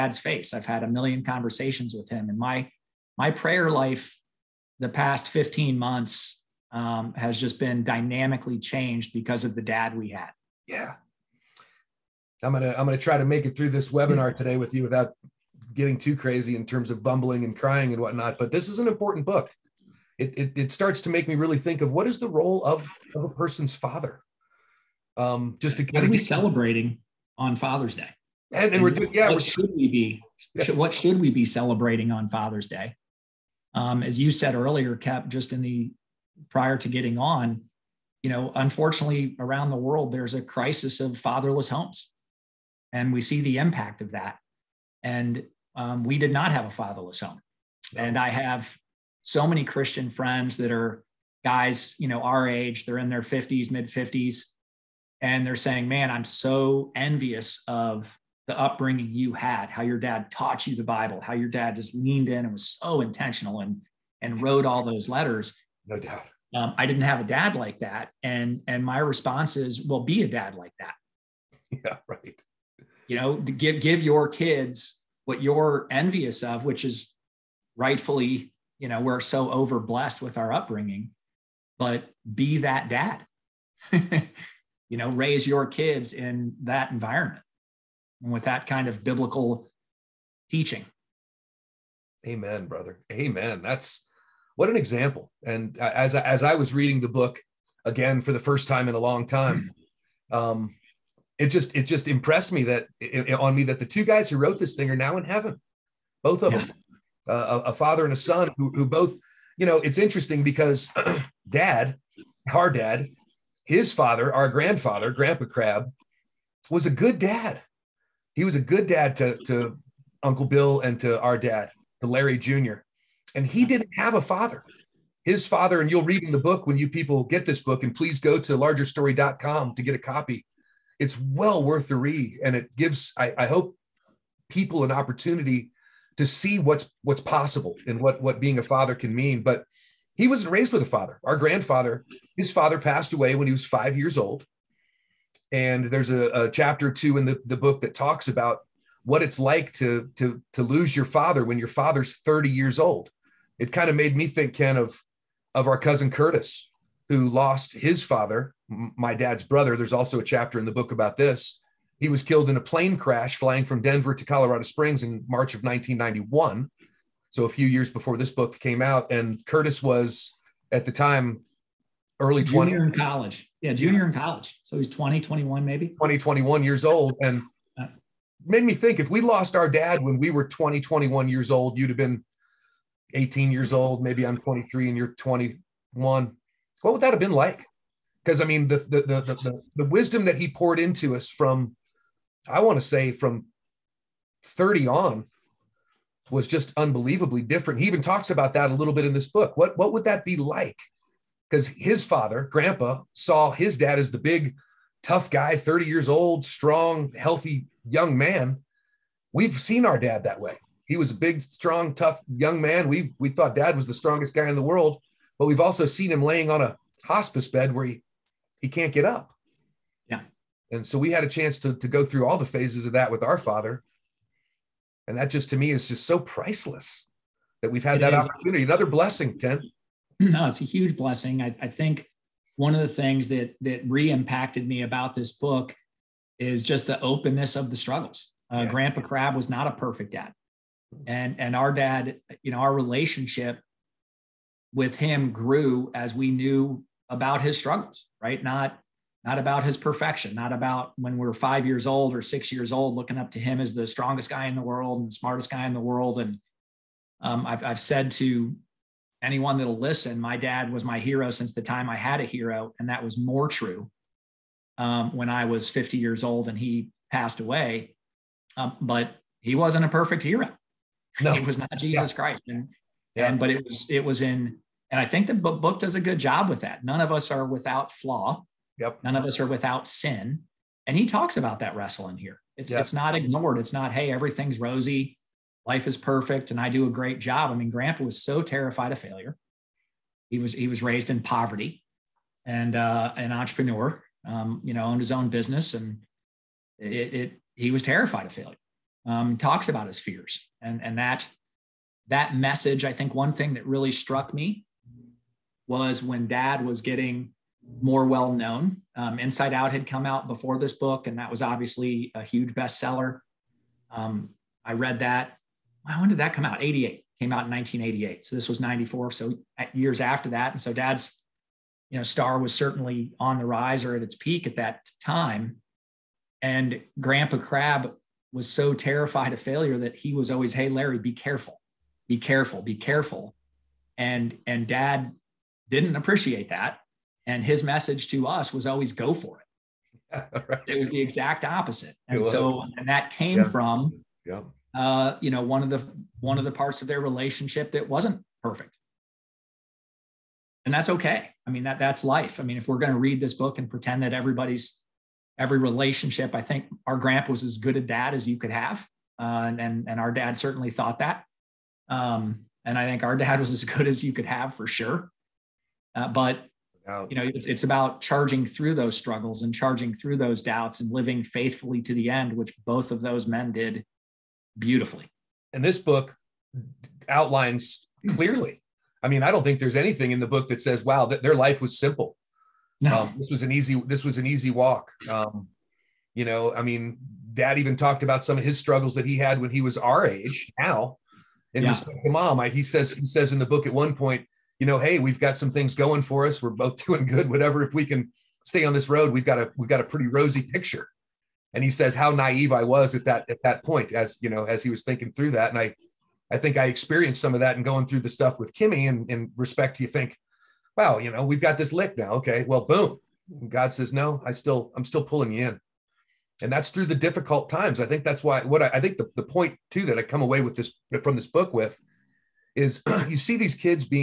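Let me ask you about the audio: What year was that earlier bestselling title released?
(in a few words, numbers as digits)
1988.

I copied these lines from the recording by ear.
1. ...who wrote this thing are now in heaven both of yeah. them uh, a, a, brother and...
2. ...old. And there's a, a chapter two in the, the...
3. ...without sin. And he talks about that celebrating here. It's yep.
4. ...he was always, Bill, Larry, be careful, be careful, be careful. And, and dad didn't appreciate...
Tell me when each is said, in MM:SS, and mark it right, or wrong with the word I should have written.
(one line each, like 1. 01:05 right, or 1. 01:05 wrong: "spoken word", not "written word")
1. 01:44 wrong: "father", not "brother"
2. 02:24 right
3. 04:39 wrong: "wrestling", not "celebrating"
4. 05:29 wrong: "Hey", not "Bill".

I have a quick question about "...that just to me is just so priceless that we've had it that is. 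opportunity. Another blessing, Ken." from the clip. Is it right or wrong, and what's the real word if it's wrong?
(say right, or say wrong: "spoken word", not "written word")
right.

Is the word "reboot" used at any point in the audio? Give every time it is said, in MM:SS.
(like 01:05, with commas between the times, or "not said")
not said.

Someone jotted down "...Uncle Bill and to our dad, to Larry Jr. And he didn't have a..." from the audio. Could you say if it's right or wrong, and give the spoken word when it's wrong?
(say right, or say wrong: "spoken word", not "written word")
right.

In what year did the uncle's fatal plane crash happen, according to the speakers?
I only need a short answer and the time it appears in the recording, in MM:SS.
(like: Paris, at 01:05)
1991, at 02:45.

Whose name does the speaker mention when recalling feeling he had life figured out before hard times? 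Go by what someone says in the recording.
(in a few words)
Kimmy.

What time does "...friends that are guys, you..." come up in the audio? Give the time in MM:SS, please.
00:50.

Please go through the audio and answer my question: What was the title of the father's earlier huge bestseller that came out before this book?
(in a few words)
Inside Out.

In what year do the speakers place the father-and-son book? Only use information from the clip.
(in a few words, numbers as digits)
1994.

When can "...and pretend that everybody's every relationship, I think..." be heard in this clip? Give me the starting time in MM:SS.
05:53.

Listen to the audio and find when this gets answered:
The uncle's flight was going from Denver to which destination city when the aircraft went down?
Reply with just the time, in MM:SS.
02:44.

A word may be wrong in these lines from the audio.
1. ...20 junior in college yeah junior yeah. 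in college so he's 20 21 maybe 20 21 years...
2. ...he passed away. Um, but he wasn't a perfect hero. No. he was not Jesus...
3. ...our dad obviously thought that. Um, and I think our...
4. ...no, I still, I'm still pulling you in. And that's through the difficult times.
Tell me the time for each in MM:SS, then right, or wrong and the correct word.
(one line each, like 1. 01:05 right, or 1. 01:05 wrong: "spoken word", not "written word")
1. 02:52 right
2. 04:26 right
3. 05:59 wrong: "certainly", not "obviously"
4. 06:53 right.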